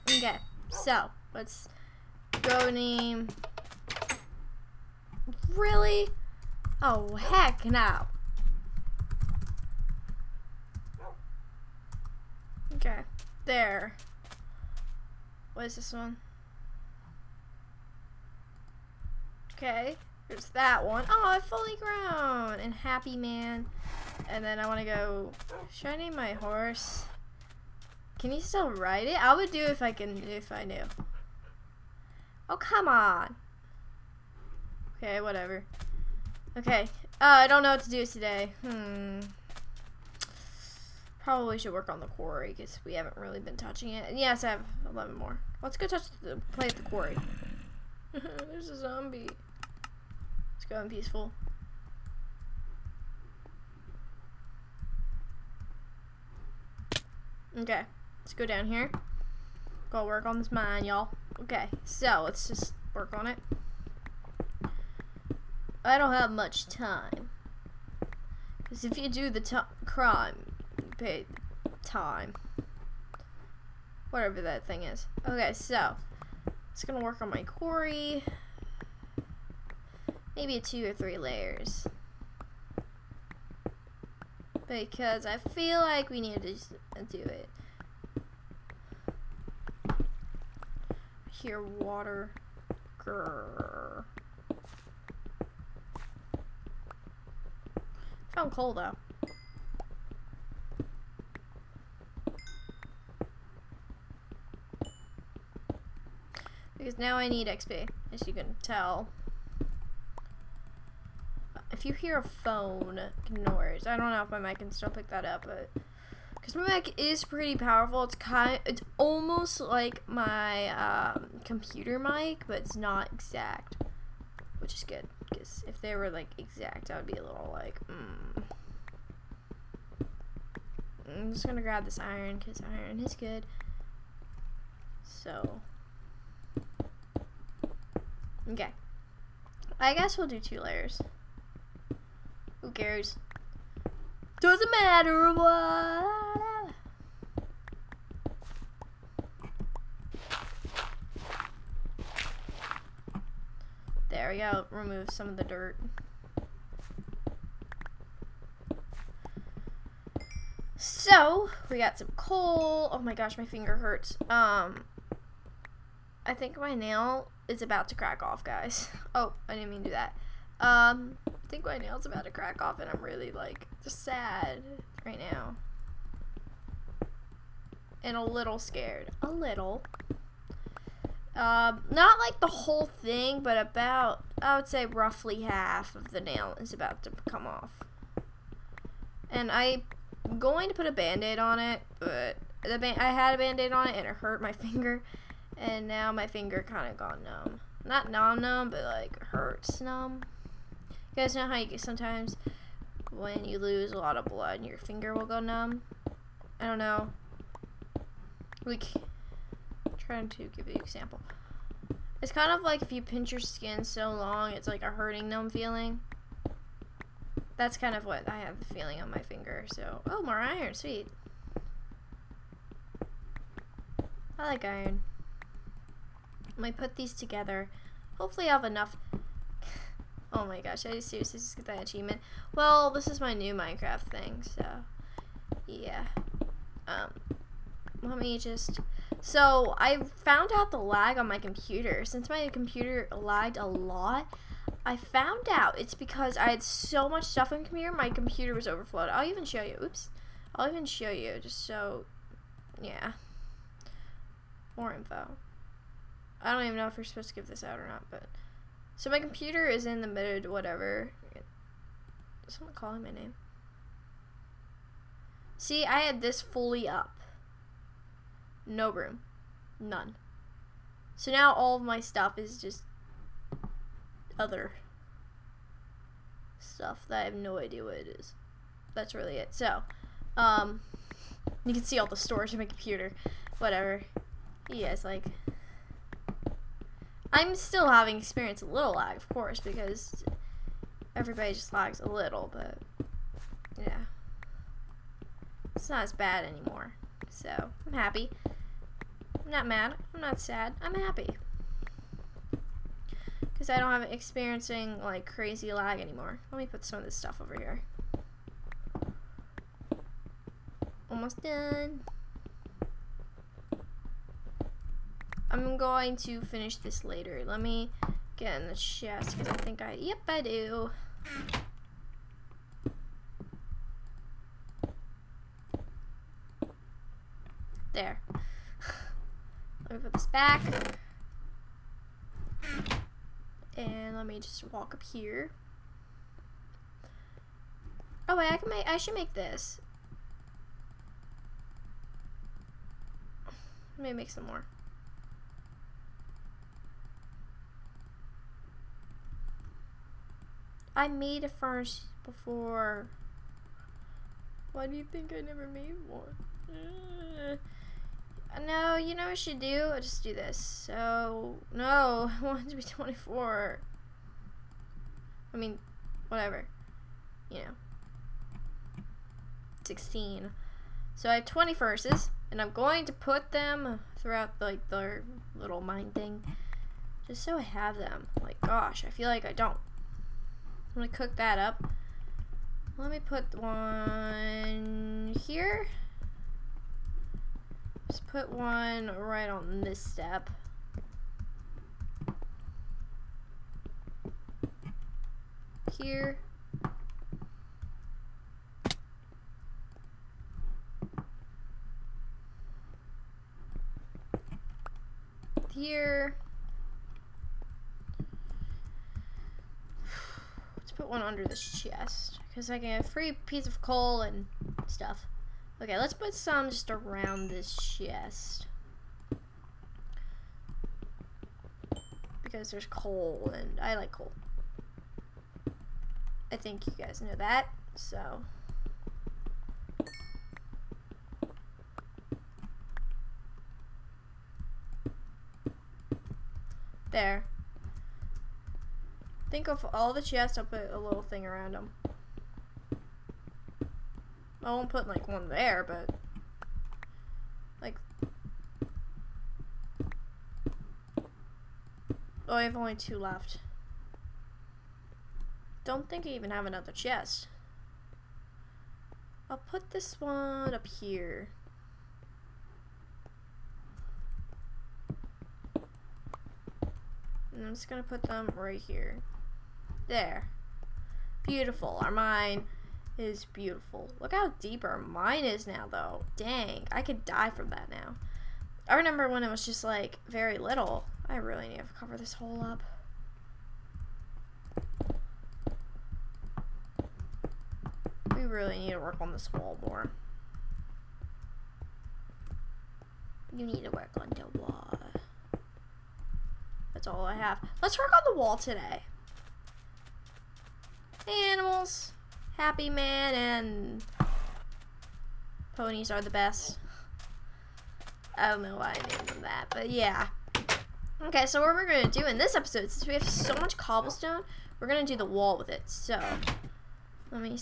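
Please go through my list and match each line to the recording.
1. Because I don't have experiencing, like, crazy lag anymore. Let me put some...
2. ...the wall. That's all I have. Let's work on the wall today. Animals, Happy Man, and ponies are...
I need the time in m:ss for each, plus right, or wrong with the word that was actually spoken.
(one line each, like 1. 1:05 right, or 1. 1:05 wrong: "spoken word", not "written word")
1. 5:03 right
2. 8:14 right.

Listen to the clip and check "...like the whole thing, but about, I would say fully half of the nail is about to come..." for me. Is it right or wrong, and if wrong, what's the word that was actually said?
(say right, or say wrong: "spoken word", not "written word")
wrong: "roughly", not "fully".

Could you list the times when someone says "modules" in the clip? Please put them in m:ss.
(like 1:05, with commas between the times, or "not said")
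not said.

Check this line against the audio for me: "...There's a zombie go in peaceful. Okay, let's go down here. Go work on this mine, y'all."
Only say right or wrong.
right.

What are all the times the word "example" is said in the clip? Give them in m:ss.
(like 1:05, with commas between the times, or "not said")
3:30.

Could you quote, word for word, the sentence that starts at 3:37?
That's kind of what I have the feeling on my finger.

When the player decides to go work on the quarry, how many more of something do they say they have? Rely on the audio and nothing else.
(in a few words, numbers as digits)
11.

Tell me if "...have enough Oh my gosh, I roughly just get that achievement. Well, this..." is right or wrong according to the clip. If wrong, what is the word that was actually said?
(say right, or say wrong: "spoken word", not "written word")
wrong: "seriously", not "roughly".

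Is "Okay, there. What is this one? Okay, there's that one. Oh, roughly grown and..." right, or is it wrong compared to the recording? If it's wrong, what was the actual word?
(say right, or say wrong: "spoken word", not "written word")
wrong: "fully", not "roughly".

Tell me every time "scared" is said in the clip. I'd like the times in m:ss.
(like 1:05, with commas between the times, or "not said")
2:58.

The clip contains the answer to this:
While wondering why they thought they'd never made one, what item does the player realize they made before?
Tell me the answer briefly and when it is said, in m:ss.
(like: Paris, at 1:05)
furnace, at 5:51.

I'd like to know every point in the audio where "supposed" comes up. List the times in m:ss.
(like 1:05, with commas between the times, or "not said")
4:17.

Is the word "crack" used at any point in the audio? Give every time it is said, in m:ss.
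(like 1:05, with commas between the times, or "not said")
2:47, 2:52.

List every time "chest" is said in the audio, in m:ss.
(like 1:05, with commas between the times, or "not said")
5:18, 6:51, 6:57, 7:20, 7:36.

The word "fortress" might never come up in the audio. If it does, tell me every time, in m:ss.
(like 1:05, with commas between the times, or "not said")
not said.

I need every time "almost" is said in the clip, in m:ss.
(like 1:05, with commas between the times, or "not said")
1:58, 5:11.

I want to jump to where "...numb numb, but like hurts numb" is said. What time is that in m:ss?
3:18.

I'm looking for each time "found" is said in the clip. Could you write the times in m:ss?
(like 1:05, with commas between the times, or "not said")
1:38, 3:59, 4:04.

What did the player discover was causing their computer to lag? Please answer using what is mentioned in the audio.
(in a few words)
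computer was overflowed.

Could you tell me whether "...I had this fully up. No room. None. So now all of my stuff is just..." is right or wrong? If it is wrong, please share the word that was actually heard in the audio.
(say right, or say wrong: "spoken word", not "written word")
right.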